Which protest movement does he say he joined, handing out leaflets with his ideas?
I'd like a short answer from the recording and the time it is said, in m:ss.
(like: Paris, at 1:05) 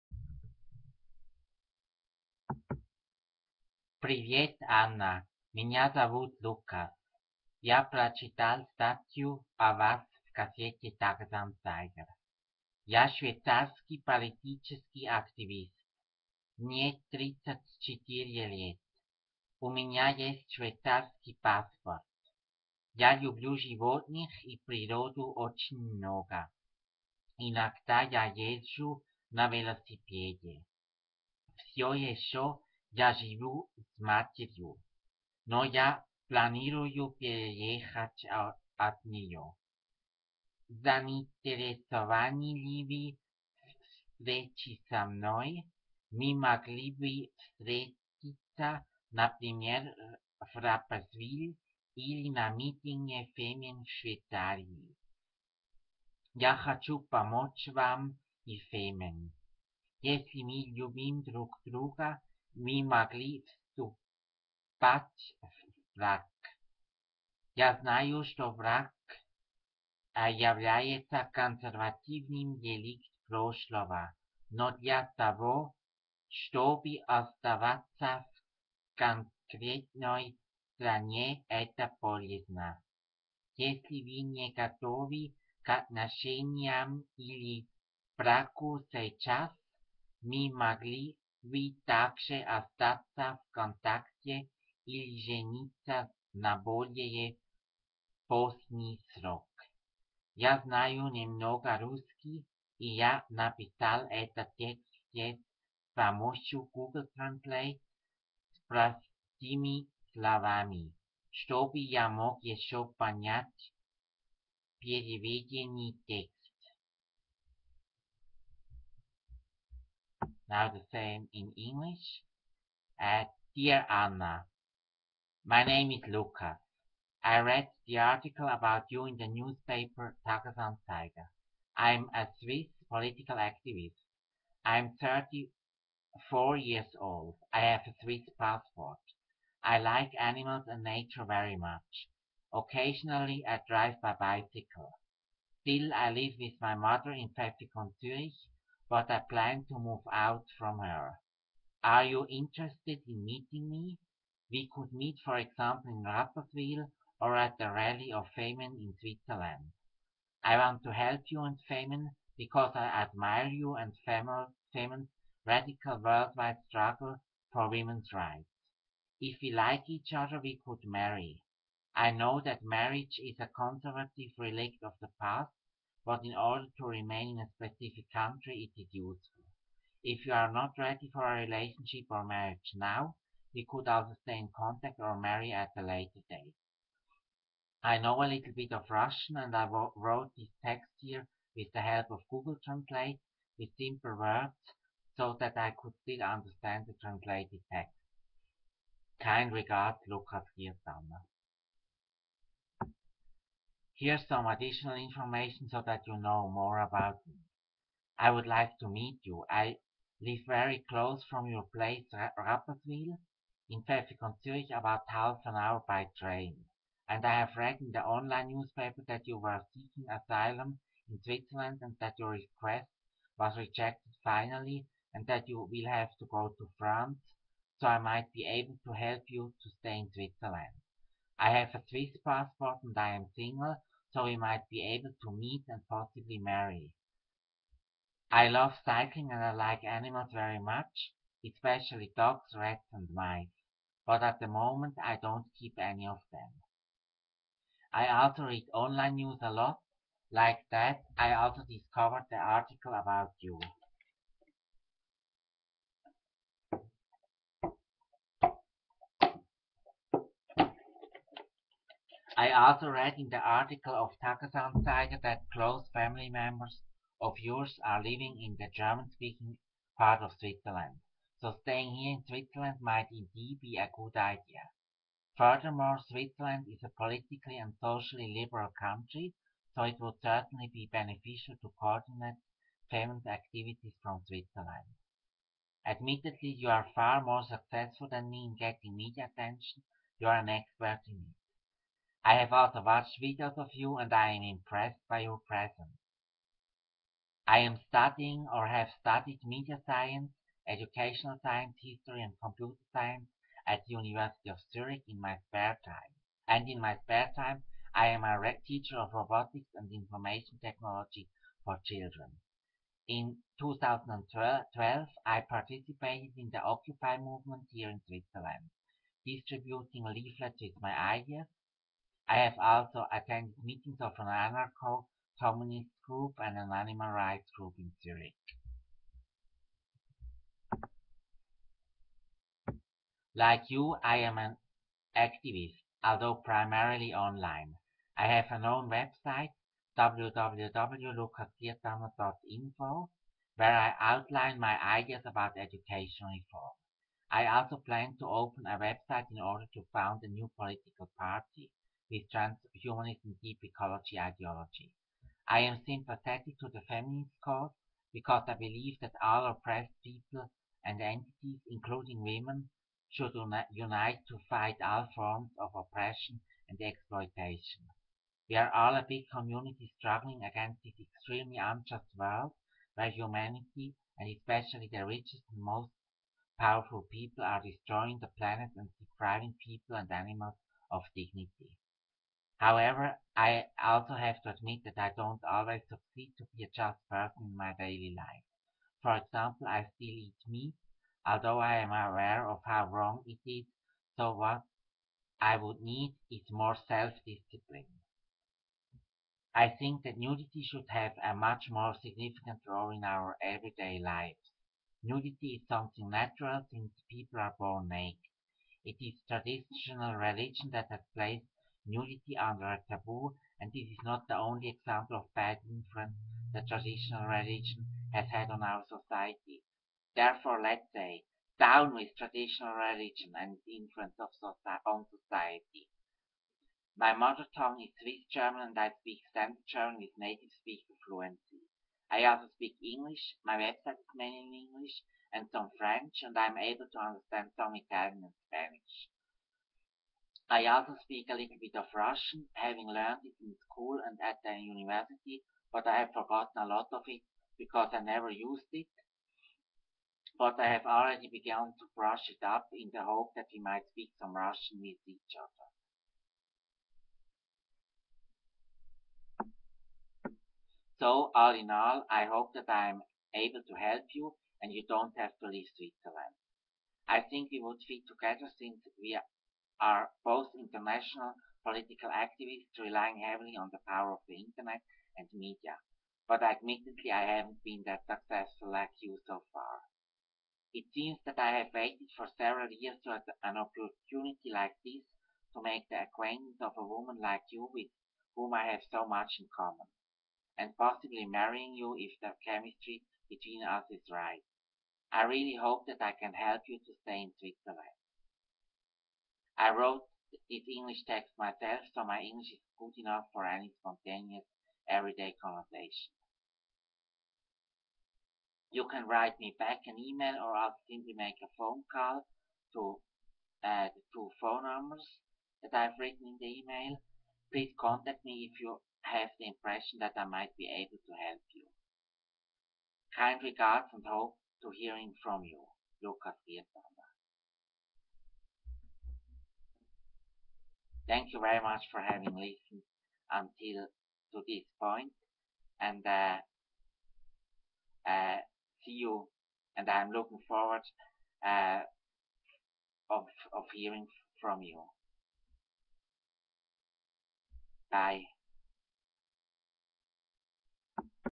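Occupy, at 5:16.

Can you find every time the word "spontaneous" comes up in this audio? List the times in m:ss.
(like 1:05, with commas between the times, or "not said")
8:23.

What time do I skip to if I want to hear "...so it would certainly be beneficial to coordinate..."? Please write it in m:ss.
4:39.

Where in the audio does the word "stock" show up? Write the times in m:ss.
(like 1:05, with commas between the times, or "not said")
not said.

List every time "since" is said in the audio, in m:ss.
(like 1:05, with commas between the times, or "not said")
6:46, 7:48.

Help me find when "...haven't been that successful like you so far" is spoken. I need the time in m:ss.
7:57.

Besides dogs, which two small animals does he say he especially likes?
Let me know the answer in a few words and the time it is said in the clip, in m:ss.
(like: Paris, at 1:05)
rats and mice, at 4:02.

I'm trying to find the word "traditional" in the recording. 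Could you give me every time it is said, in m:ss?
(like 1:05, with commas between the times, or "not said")
6:49, 6:56, 7:02.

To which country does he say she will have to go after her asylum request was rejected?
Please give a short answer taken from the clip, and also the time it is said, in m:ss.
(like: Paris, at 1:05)
France, at 3:46.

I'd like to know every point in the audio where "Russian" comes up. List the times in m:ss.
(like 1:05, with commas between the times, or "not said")
3:08, 7:21, 7:34.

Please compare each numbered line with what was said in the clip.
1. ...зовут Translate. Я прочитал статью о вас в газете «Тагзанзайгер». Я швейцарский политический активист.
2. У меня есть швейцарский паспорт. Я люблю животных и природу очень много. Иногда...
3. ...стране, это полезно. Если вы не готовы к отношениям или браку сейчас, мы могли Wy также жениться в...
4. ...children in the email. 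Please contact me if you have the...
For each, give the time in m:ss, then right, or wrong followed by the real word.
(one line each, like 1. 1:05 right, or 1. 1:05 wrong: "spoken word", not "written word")
1. 0:05 wrong: "Лука", not "Translate"
2. 0:19 right
3. 1:20 wrong: "остаться", not "жениться"
4. 8:35 wrong: "written", not "children".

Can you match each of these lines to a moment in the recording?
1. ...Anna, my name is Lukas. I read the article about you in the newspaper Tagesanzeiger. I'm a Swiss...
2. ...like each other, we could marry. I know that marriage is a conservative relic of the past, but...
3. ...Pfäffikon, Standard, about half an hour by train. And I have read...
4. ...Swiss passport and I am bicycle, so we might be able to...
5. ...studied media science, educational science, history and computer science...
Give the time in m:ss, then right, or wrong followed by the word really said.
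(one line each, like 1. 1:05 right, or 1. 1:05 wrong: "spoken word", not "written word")
1. 2:03 right
2. 2:49 right
3. 3:33 wrong: "Zurich", not "Standard"
4. 3:51 wrong: "single", not "bicycle"
5. 4:58 right.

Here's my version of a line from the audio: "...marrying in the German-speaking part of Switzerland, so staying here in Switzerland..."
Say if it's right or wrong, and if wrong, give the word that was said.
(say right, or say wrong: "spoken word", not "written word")
wrong: "living", not "marrying".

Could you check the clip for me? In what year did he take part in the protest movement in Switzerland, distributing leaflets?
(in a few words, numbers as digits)
2012.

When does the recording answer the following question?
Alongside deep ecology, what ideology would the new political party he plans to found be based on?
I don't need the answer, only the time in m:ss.
5:52.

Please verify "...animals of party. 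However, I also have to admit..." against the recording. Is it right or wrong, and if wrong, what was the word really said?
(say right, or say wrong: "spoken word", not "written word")
wrong: "dignity", not "party".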